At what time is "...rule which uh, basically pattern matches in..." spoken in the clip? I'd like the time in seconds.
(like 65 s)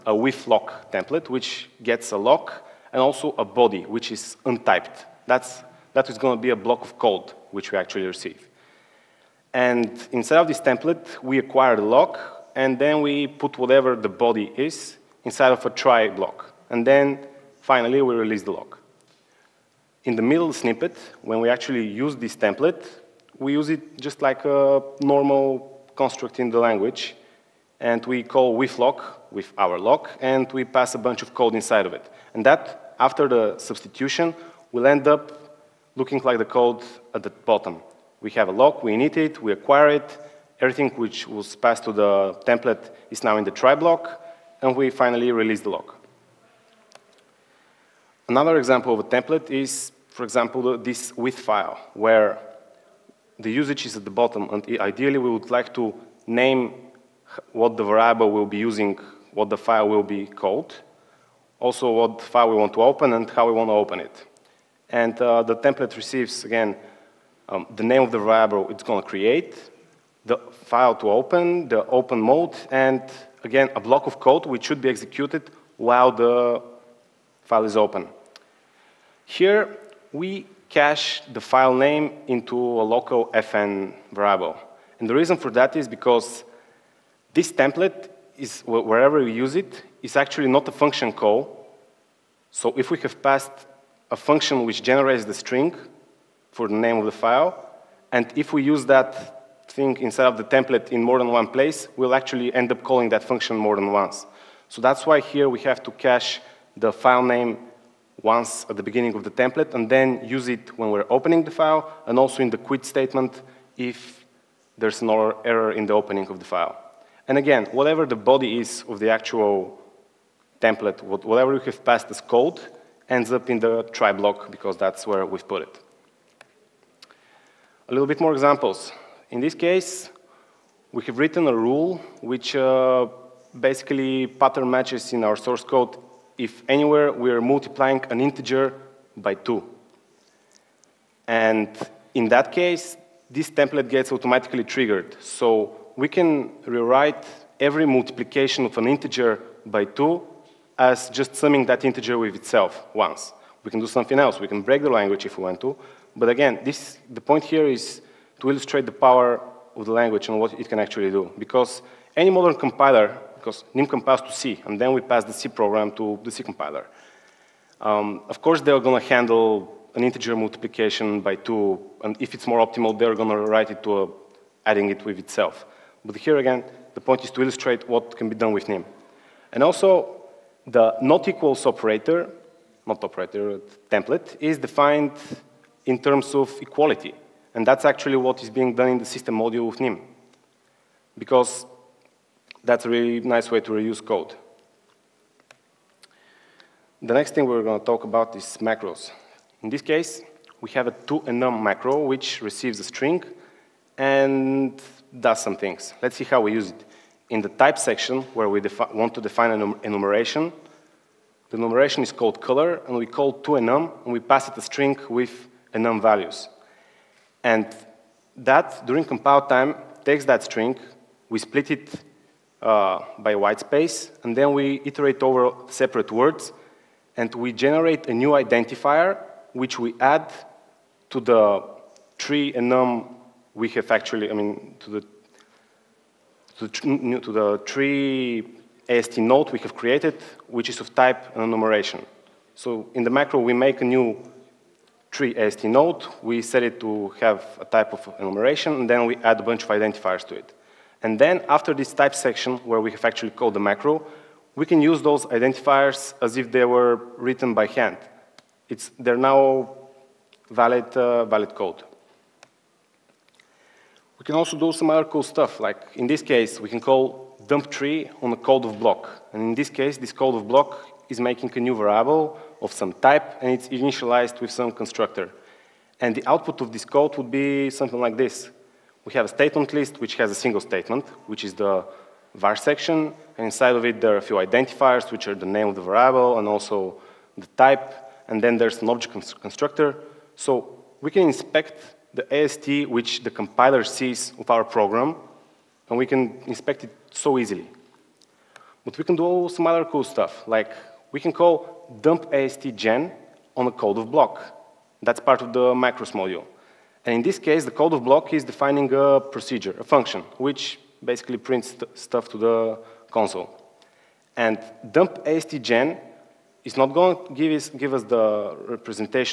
131 s.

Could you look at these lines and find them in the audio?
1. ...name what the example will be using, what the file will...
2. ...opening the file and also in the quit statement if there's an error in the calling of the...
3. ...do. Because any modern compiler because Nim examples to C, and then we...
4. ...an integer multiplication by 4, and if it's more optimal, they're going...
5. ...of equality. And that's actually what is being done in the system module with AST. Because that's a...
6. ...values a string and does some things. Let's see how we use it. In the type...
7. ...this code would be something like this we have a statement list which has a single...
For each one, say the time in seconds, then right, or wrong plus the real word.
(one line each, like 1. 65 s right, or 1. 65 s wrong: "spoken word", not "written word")
1. 56 s wrong: "variable", not "example"
2. 111 s wrong: "opening", not "calling"
3. 161 s wrong: "compiles", not "examples"
4. 169 s wrong: "2", not "4"
5. 186 s wrong: "NIM", not "AST"
6. 202 s wrong: "receives", not "values"
7. 276 s right.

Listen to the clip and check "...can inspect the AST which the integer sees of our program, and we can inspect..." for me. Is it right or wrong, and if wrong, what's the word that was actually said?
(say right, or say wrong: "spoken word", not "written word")
wrong: "compiler", not "integer".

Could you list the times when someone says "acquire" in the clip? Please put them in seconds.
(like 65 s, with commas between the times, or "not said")
11 s, 39 s.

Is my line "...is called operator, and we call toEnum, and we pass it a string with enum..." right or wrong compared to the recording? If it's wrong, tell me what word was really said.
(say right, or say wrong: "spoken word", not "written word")
wrong: "color", not "operator".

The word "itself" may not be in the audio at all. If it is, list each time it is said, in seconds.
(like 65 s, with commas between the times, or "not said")
152 s, 175 s.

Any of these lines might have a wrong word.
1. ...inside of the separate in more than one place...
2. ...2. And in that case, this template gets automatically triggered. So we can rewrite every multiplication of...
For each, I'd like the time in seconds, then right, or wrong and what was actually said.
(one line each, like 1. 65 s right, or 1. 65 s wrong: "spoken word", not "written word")
1. 99 s wrong: "template", not "separate"
2. 139 s right.